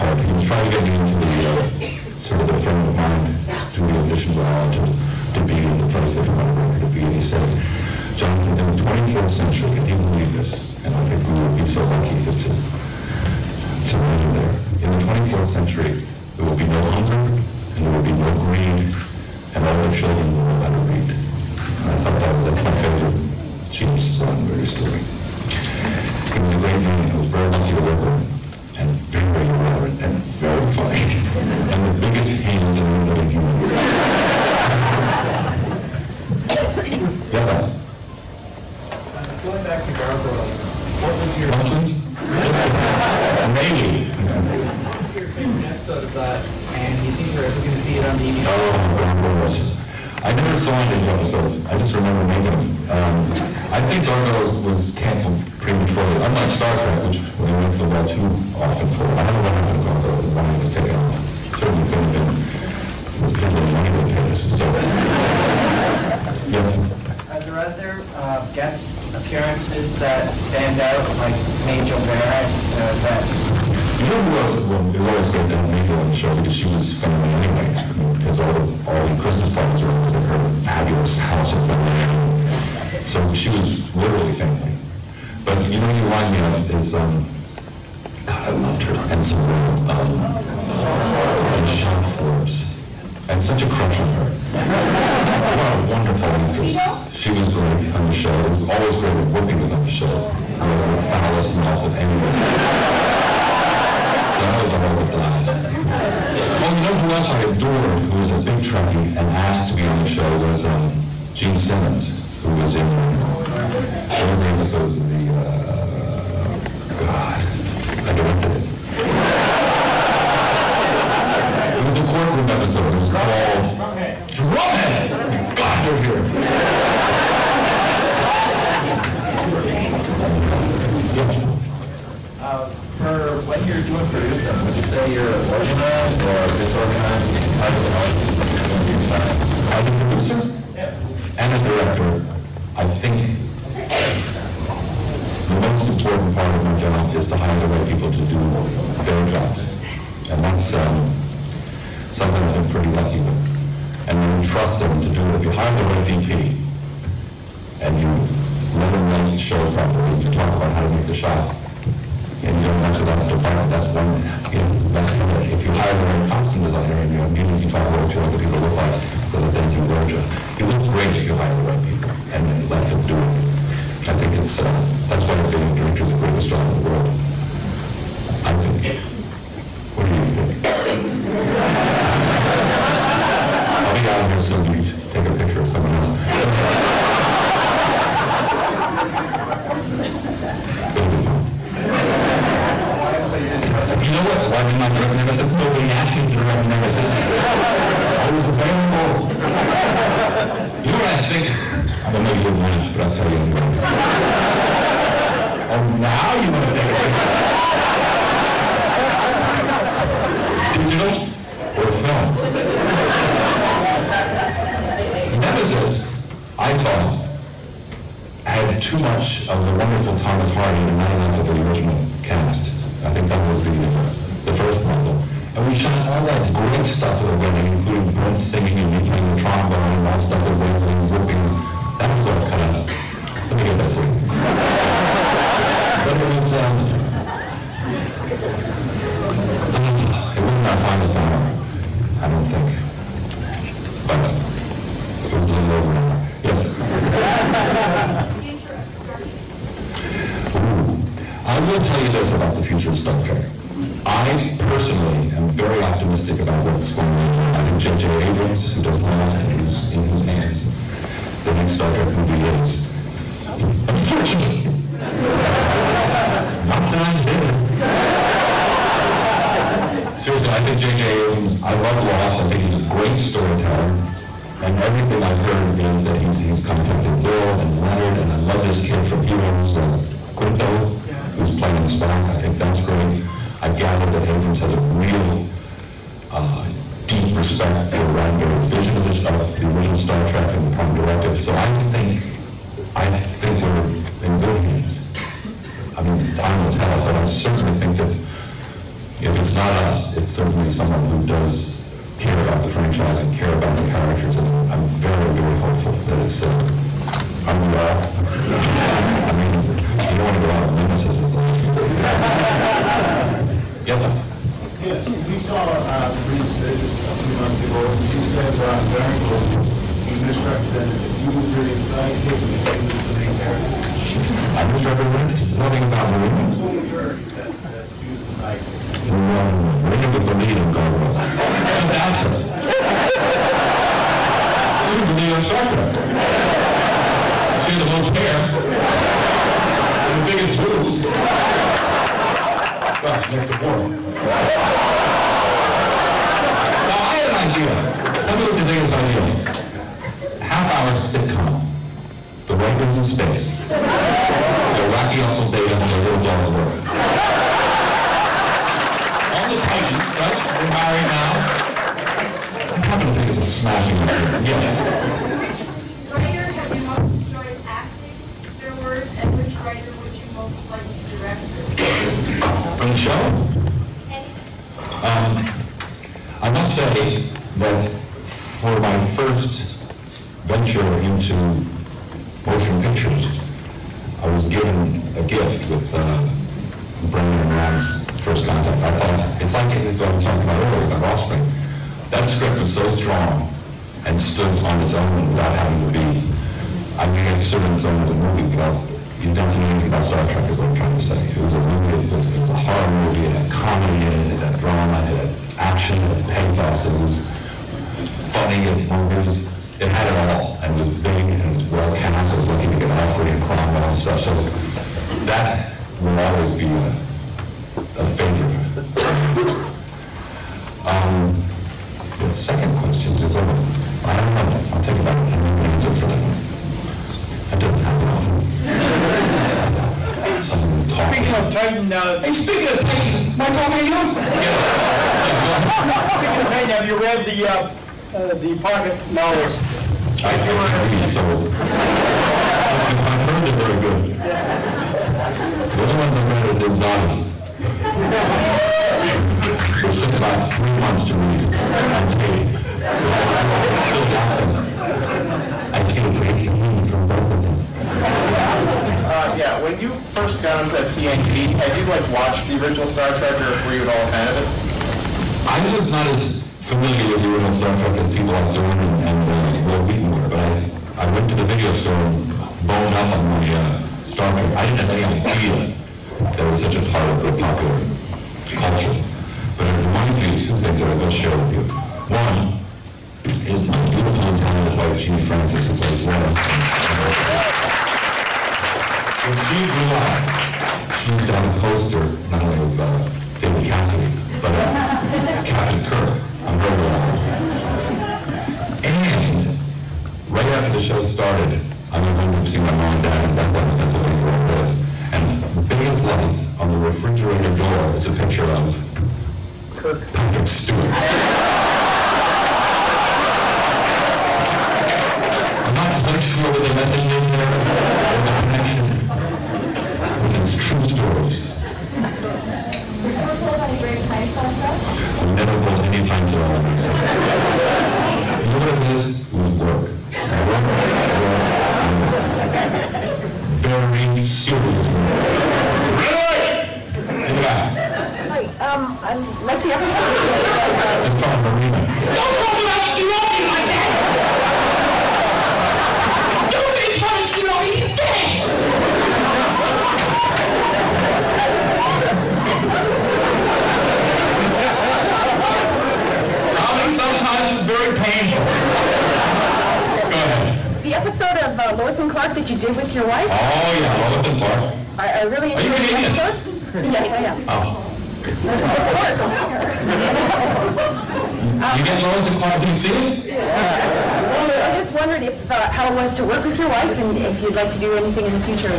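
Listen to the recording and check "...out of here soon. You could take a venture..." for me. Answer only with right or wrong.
wrong.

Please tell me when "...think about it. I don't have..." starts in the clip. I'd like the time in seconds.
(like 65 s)
424 s.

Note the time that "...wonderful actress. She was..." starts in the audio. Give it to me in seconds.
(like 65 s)
95 s.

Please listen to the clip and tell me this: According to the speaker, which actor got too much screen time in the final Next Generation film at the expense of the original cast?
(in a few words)
Thomas Hardy.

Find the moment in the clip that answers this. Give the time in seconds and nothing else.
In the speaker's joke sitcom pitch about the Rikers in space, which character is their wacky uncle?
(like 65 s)
355 s.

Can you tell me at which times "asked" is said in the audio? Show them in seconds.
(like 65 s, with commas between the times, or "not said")
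109 s, 195 s.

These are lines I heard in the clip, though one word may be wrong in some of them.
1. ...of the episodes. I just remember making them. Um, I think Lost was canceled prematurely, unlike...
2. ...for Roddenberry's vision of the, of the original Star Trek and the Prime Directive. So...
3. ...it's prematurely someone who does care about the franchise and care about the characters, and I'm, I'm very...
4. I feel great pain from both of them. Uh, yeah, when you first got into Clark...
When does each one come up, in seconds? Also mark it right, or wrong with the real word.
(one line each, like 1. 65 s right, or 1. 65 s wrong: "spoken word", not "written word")
1. 50 s wrong: "Gargoyles", not "Lost"
2. 287 s right
3. 300 s wrong: "certainly", not "prematurely"
4. 455 s wrong: "TNG", not "Clark".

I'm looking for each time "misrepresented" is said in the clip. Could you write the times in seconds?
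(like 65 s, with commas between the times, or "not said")
320 s, 324 s.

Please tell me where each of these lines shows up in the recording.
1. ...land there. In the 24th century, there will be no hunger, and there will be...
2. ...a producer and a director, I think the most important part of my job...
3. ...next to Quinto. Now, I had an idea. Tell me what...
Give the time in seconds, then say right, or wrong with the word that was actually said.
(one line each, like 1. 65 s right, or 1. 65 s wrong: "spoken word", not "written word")
1. 13 s right
2. 139 s right
3. 343 s wrong: "Worf", not "Quinto".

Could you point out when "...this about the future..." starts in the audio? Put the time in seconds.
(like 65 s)
252 s.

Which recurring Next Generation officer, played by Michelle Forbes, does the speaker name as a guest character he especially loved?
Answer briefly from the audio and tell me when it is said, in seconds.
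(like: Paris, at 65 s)
Ensign Ro, at 89 s.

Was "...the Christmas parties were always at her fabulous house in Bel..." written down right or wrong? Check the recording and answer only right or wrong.
right.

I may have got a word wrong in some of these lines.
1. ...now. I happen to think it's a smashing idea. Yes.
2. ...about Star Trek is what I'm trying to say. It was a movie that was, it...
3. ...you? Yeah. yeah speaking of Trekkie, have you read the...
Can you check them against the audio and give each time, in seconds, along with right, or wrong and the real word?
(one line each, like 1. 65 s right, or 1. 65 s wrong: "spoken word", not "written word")
1. 361 s right
2. 399 s right
3. 433 s wrong: "Titan", not "Trekkie".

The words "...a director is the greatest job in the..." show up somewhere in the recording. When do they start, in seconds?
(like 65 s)
175 s.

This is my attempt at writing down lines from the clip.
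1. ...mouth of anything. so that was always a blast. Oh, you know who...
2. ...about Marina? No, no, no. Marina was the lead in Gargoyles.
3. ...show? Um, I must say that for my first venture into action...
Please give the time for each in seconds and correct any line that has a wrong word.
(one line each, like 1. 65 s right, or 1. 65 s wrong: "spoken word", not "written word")
1. 101 s right
2. 325 s right
3. 372 s wrong: "motion", not "action".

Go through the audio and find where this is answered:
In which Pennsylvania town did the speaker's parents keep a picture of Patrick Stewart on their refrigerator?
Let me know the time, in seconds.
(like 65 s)
503 s.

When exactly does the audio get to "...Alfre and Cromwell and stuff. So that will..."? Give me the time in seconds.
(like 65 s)
412 s.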